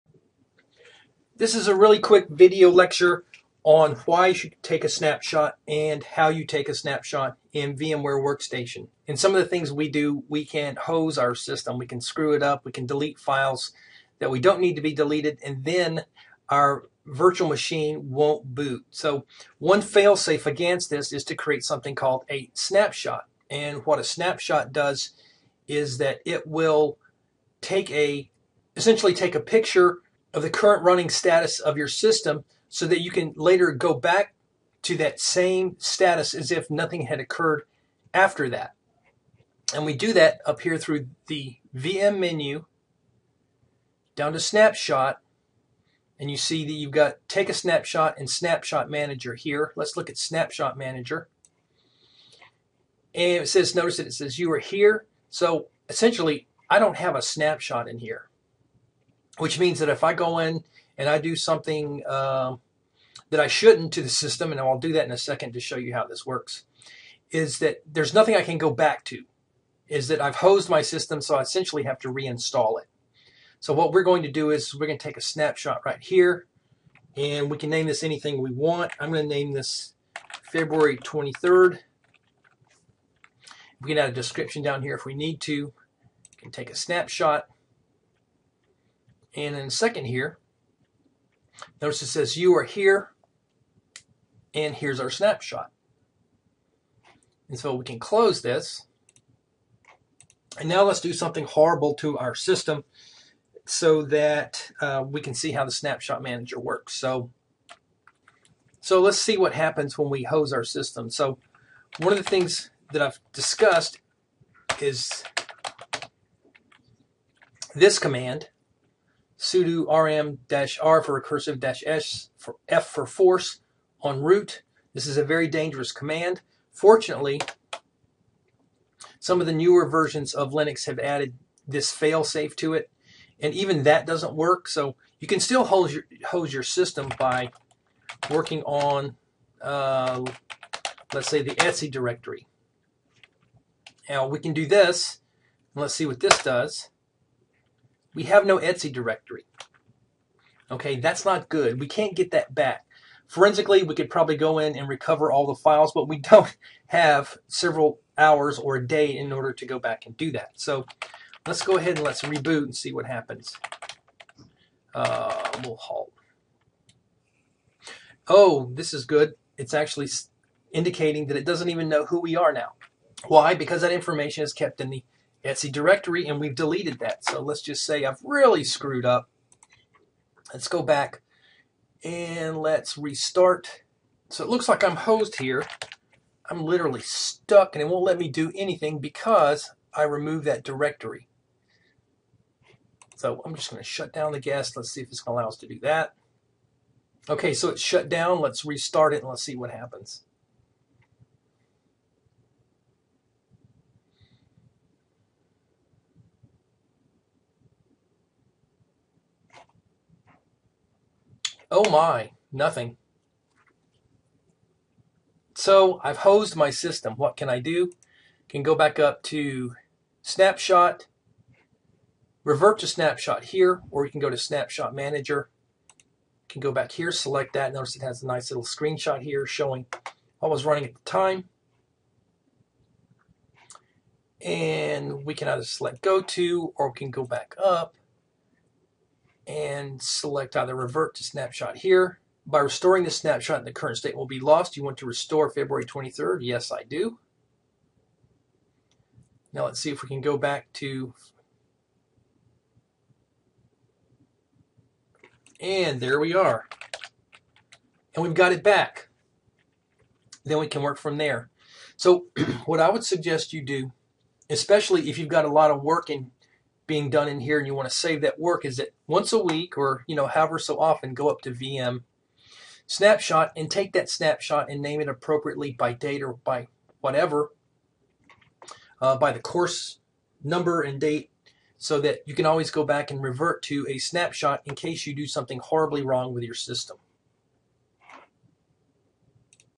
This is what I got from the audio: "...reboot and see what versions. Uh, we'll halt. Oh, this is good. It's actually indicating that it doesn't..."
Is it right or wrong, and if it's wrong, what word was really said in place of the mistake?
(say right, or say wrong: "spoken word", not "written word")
wrong: "happens", not "versions".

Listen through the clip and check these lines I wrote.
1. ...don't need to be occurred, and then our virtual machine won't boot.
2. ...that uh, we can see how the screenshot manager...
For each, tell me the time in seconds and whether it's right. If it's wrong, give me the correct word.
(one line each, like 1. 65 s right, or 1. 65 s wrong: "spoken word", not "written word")
1. 14 s wrong: "deleted", not "occurred"
2. 104 s wrong: "snapshot", not "screenshot".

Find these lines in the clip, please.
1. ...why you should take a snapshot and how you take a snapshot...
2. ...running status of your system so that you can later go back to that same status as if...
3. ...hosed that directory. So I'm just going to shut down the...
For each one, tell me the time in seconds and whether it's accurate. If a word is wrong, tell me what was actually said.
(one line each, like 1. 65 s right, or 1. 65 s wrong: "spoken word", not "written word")
1. 4 s right
2. 30 s right
3. 190 s wrong: "removed", not "hosed".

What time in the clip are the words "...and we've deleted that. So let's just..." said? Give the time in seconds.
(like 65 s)
176 s.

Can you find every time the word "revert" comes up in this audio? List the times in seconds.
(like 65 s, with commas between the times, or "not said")
222 s, 240 s, 283 s.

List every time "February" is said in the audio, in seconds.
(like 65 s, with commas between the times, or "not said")
80 s, 245 s.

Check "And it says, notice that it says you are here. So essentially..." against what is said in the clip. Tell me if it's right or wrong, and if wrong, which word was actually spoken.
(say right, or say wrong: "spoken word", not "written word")
right.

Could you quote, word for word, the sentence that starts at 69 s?
Is that I've hosed my system, so I essentially have to reinstall it.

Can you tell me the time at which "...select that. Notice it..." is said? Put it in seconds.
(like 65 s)
227 s.